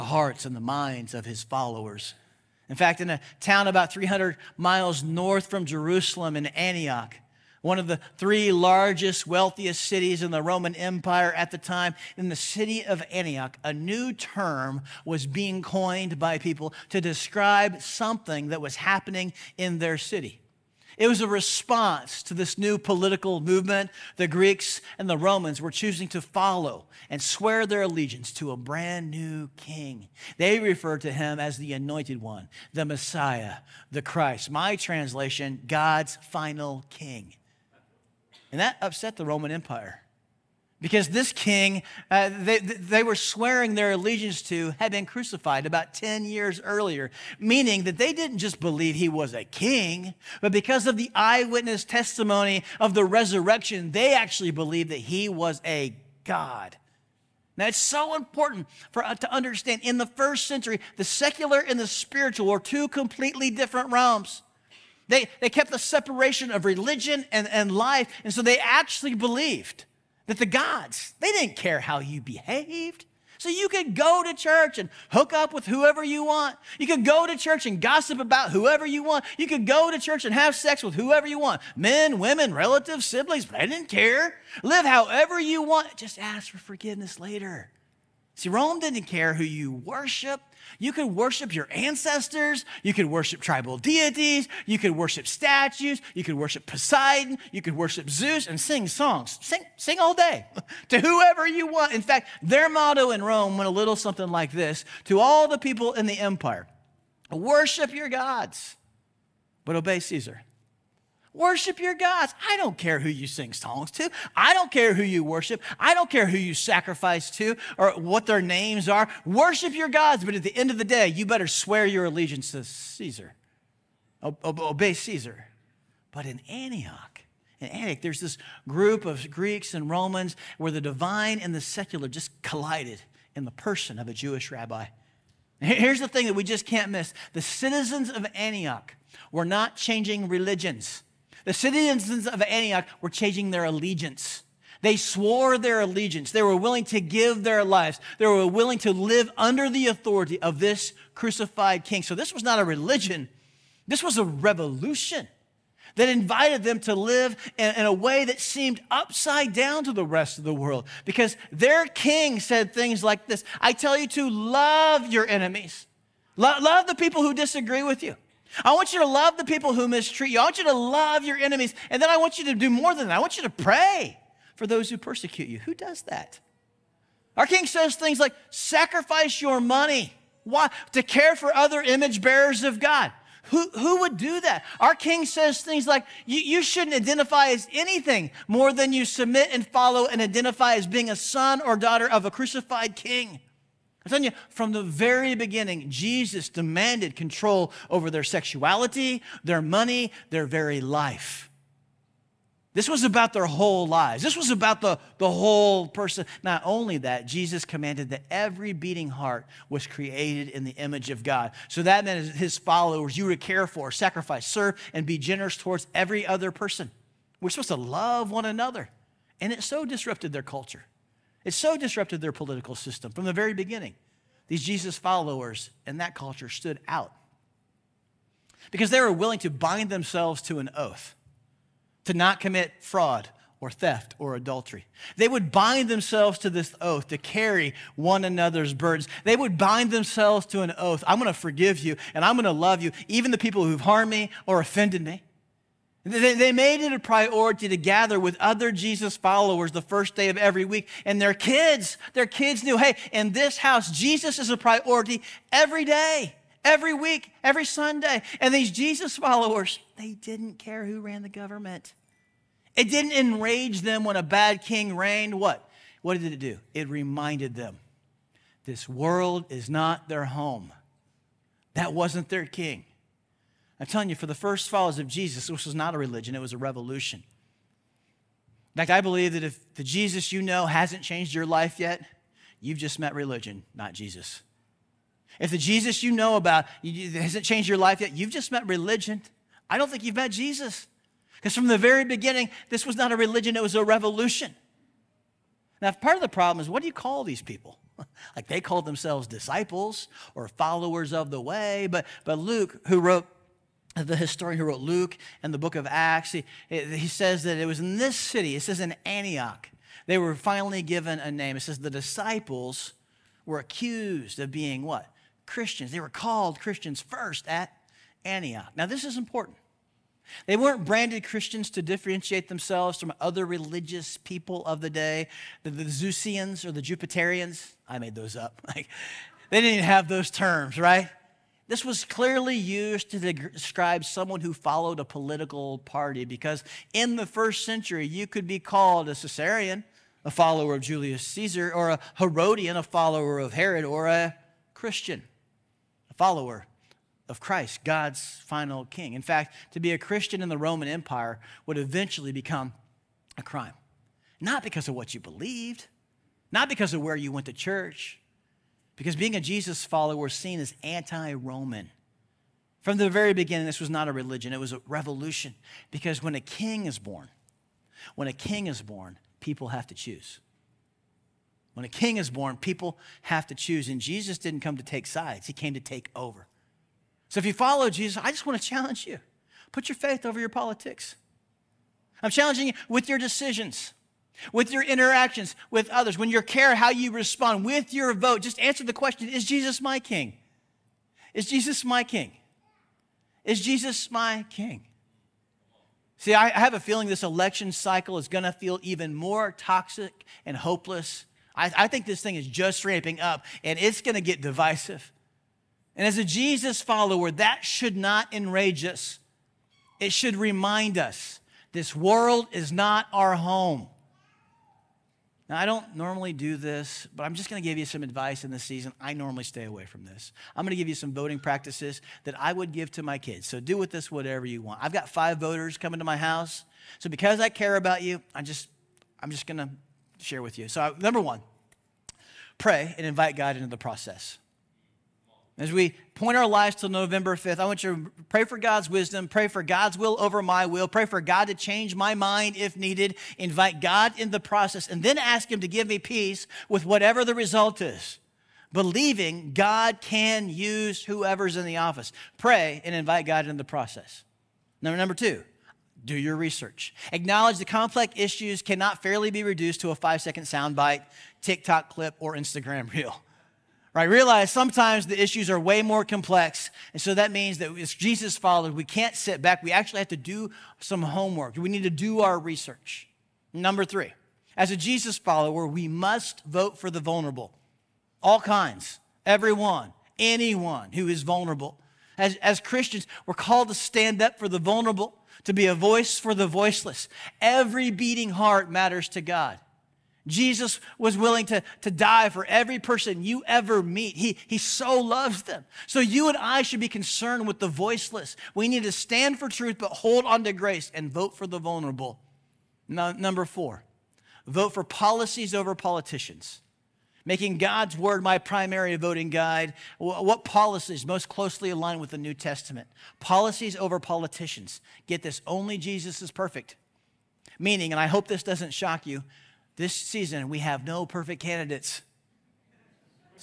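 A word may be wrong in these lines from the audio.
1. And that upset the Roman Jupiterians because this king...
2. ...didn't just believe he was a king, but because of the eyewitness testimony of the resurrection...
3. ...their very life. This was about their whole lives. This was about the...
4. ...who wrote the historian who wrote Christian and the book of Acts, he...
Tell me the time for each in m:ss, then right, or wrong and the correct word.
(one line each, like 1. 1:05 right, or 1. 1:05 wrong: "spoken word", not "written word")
1. 0:38 wrong: "Empire", not "Jupiterians"
2. 0:48 right
3. 3:20 right
4. 5:02 wrong: "Luke", not "Christian".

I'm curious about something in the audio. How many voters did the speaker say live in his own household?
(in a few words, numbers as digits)
5.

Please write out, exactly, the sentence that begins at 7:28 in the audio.
Believing God can use whoever's in the office.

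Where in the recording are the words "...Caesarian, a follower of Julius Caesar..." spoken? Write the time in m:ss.
5:39.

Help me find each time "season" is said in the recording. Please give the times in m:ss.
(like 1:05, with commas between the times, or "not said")
6:58, 8:39.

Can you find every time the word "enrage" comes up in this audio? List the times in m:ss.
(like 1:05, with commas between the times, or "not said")
4:23, 6:48.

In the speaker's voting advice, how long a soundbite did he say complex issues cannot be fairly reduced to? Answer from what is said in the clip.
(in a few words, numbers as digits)
5 seconds.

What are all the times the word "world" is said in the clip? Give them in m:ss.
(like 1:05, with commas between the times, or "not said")
2:40, 4:28, 6:51.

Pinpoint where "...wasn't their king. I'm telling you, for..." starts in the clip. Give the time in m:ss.
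4:31.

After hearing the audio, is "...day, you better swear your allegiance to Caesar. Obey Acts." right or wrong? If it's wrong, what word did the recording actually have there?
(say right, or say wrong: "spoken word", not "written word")
wrong: "Caesar", not "Acts".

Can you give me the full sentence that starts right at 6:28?
Just answer the question Is Jesus my king?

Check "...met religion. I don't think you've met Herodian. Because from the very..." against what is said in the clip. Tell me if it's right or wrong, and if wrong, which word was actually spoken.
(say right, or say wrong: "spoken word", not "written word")
wrong: "Jesus", not "Herodian".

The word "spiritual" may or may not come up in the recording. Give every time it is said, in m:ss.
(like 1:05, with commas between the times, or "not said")
1:01.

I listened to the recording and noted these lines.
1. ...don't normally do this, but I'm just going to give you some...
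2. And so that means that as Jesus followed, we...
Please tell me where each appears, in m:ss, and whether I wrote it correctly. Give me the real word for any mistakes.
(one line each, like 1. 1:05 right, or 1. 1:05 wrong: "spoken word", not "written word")
1. 6:55 right
2. 7:46 right.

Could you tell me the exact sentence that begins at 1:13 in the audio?
So you could go to church and hook up with whoever you want.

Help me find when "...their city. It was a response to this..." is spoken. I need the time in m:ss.
0:19.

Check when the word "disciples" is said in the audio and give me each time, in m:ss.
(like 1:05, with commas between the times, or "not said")
4:59, 5:11.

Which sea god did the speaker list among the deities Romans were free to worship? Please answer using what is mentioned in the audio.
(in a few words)
Poseidon.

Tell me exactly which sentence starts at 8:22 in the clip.
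No, number four, vote for policies over politicians.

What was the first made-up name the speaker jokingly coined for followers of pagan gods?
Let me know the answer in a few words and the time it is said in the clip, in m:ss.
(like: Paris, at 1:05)
Zeusians, at 5:25.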